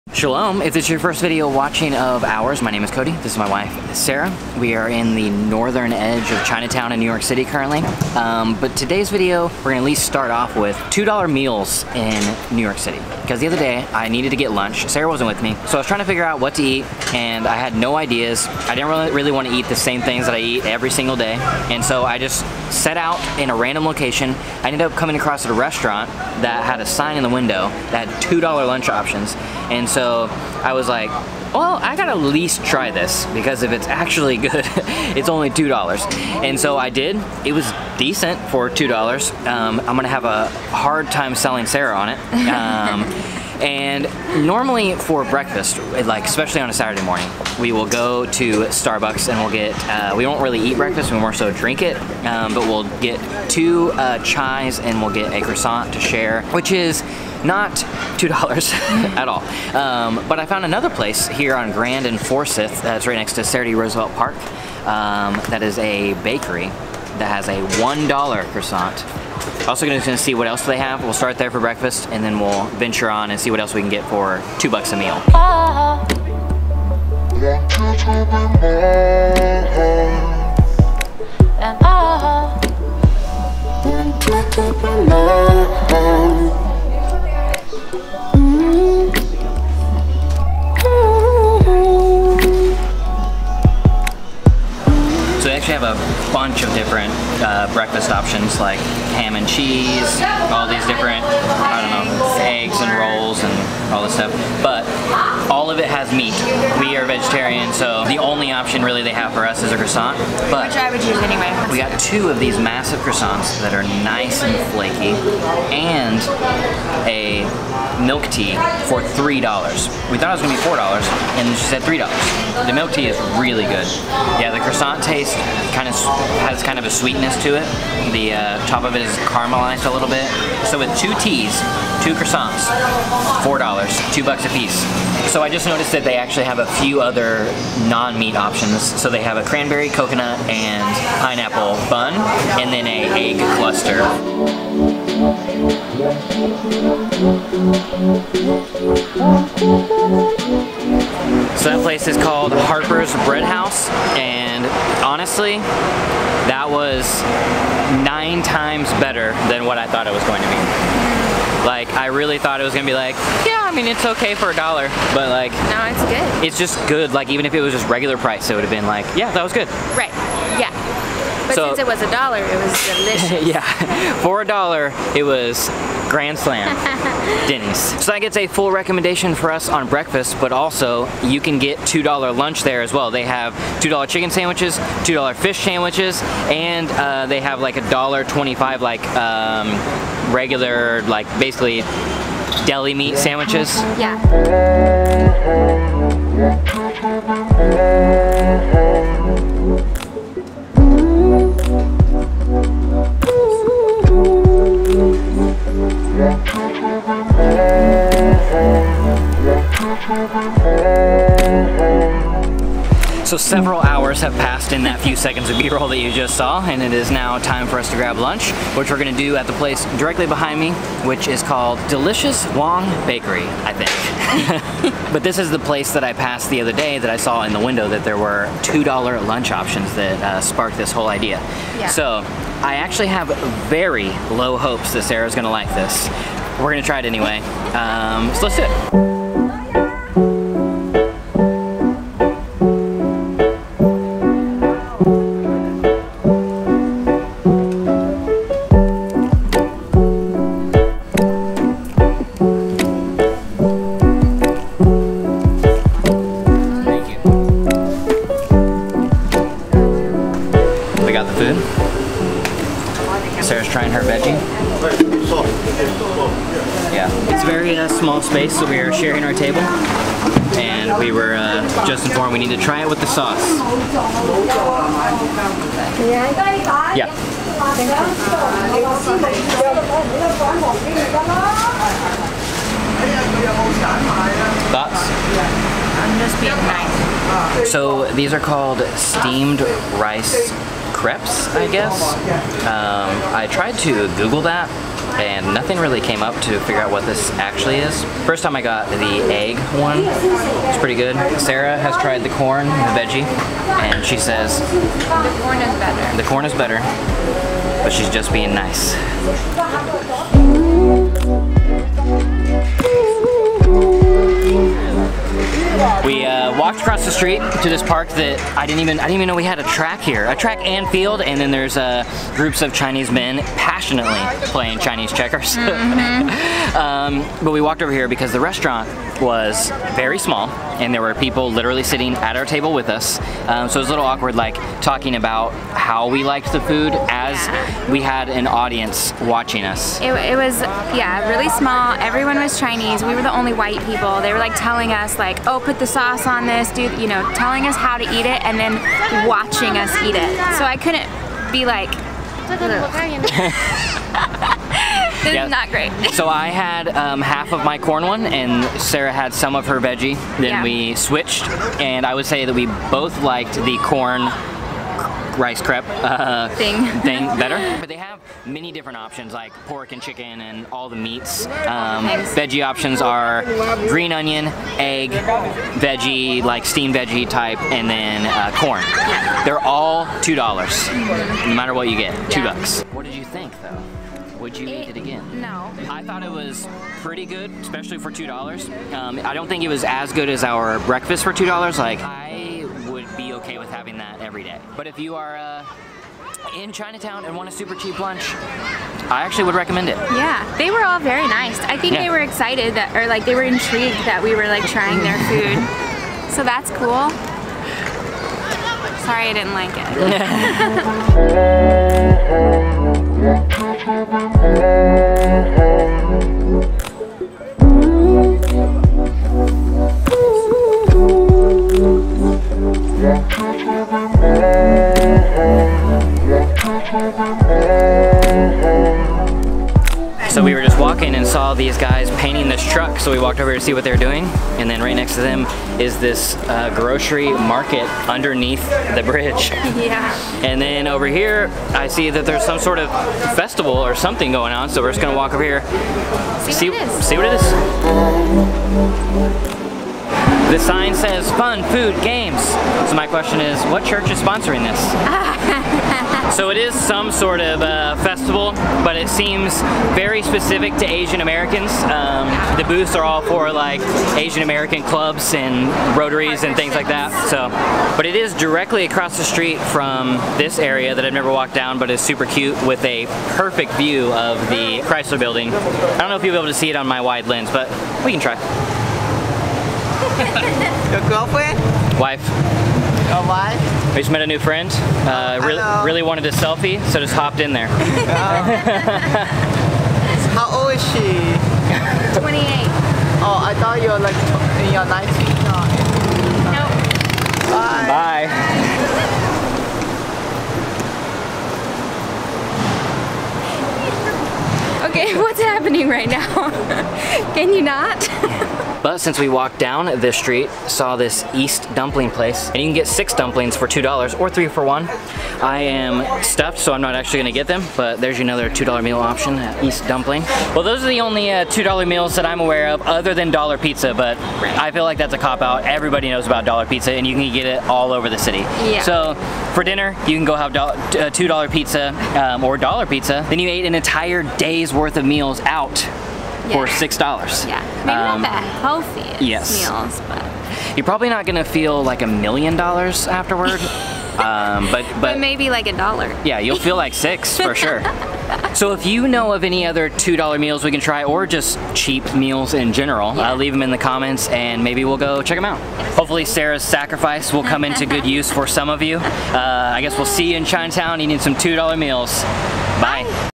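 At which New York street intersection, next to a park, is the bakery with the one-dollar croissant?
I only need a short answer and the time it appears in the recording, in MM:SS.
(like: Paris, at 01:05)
Grand and Forsyth, at 01:01.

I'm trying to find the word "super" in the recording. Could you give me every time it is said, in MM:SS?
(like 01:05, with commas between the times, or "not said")
06:37, 07:51.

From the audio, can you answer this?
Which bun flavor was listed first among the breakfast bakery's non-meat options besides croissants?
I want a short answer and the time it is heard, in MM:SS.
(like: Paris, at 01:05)
cranberry, at 02:19.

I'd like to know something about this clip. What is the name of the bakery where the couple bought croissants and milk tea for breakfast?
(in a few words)
Harper's Bread House.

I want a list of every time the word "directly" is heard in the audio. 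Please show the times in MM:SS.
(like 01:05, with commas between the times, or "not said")
03:39, 07:48.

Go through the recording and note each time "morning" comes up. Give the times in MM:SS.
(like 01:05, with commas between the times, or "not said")
00:47.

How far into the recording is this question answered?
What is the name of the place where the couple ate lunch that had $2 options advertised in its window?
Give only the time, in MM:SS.
03:41.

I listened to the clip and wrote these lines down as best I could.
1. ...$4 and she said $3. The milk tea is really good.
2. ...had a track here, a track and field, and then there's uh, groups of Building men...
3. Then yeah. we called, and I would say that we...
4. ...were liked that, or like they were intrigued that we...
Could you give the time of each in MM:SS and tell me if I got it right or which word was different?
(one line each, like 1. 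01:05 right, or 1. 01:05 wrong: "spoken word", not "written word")
1. 02:00 right
2. 05:19 wrong: "Chinese", not "Building"
3. 06:00 wrong: "switched", not "called"
4. 06:42 wrong: "excited", not "liked".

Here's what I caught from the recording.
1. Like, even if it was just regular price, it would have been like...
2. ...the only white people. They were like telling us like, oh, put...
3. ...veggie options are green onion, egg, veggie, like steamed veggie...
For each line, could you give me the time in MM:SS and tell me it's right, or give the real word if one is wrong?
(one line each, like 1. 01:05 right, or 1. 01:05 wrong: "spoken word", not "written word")
1. 02:47 right
2. 05:43 right
3. 06:12 right.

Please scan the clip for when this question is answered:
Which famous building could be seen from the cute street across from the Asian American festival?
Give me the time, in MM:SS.
07:54.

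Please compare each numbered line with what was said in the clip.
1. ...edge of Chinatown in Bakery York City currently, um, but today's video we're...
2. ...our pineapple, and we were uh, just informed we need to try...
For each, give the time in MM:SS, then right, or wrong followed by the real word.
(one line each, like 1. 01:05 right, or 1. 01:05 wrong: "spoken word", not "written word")
1. 00:05 wrong: "New", not "Bakery"
2. 04:29 wrong: "table", not "pineapple".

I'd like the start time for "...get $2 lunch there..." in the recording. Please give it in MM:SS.
03:01.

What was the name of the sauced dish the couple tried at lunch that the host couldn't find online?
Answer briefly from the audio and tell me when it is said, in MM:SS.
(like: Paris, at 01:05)
steamed rice crepes, at 04:48.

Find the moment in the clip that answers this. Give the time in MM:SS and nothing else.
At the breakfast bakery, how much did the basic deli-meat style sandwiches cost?
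03:07.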